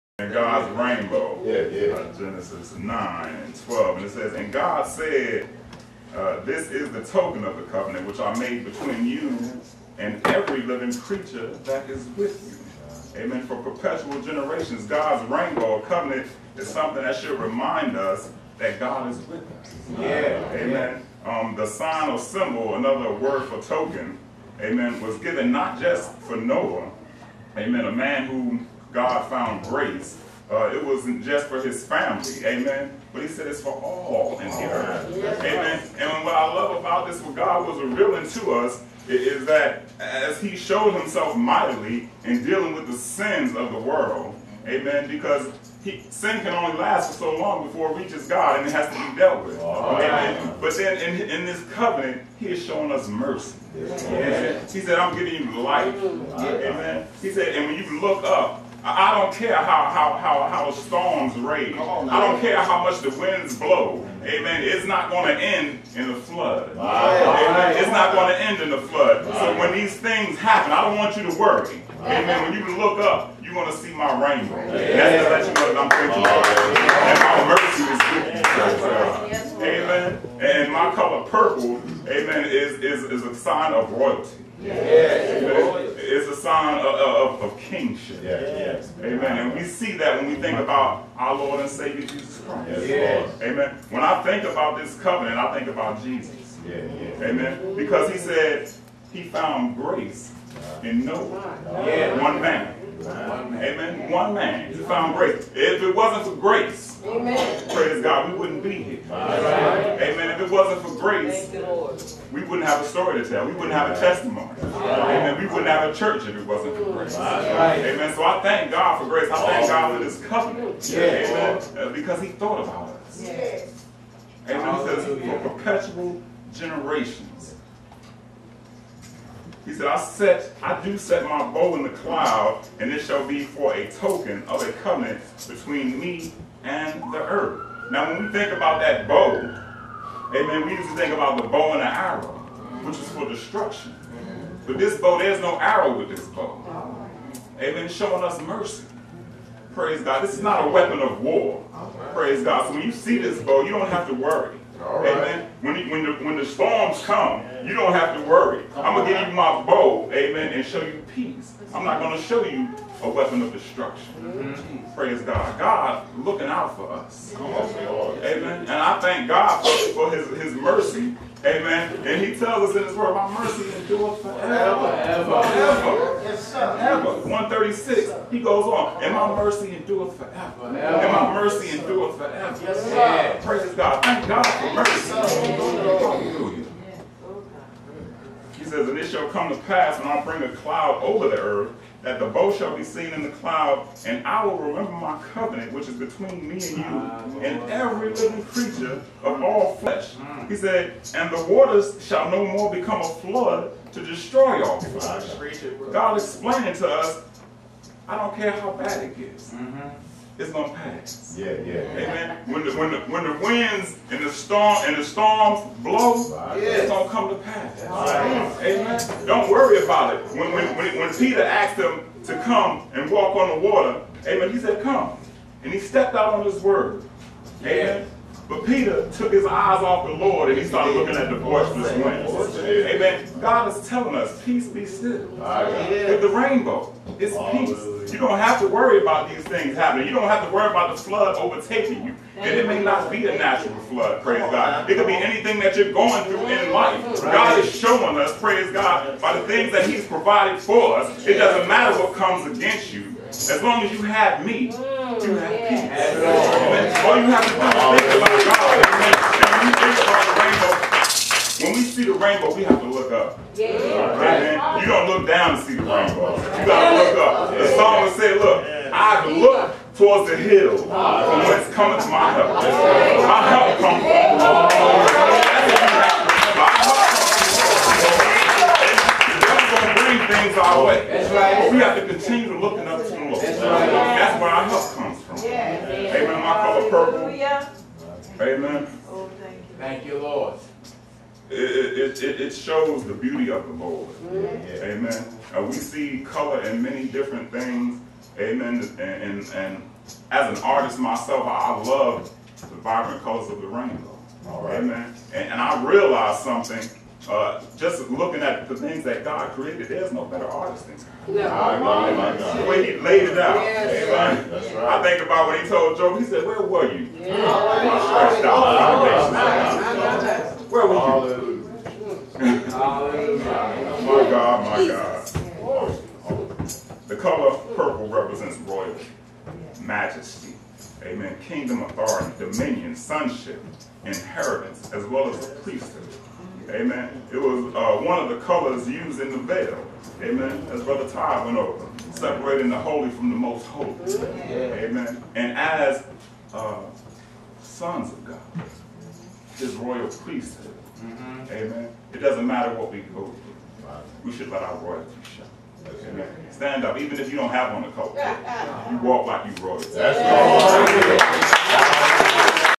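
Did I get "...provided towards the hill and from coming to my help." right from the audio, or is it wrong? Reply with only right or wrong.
wrong.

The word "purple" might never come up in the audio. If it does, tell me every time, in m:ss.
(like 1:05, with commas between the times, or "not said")
1:21, 4:46, 5:27.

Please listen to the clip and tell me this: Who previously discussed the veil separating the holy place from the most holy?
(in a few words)
Brother Todd.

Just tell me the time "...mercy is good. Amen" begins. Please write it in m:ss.
1:19.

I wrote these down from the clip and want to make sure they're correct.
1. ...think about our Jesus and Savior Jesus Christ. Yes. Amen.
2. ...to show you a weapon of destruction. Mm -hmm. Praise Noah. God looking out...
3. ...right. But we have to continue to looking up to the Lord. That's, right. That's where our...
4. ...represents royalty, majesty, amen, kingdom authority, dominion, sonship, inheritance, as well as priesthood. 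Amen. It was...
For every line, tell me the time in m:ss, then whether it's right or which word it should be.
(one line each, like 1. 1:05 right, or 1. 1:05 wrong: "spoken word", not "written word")
1. 1:30 wrong: "Lord", not "Jesus"
2. 2:42 wrong: "God", not "Noah"
3. 4:41 right
4. 5:28 right.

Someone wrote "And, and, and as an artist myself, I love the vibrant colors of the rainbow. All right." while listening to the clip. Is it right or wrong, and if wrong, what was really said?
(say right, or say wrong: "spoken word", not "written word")
right.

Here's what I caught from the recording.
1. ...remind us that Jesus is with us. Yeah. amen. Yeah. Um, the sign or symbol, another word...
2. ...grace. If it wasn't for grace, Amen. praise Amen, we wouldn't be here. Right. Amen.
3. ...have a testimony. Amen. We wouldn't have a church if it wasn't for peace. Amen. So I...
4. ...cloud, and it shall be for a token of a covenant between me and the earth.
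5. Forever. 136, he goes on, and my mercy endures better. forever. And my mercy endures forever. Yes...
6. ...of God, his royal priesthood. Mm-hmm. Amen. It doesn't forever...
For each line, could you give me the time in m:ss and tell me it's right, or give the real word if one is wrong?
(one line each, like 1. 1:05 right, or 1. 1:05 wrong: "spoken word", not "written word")
1. 0:17 wrong: "God", not "Jesus"
2. 1:45 wrong: "God", not "Amen"
3. 1:53 wrong: "grace", not "peace"
4. 2:11 right
5. 2:56 wrong: "forever", not "better"
6. 5:48 wrong: "matter", not "forever".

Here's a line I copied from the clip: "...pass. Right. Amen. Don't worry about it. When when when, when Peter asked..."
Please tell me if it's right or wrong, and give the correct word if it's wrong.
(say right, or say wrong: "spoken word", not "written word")
right.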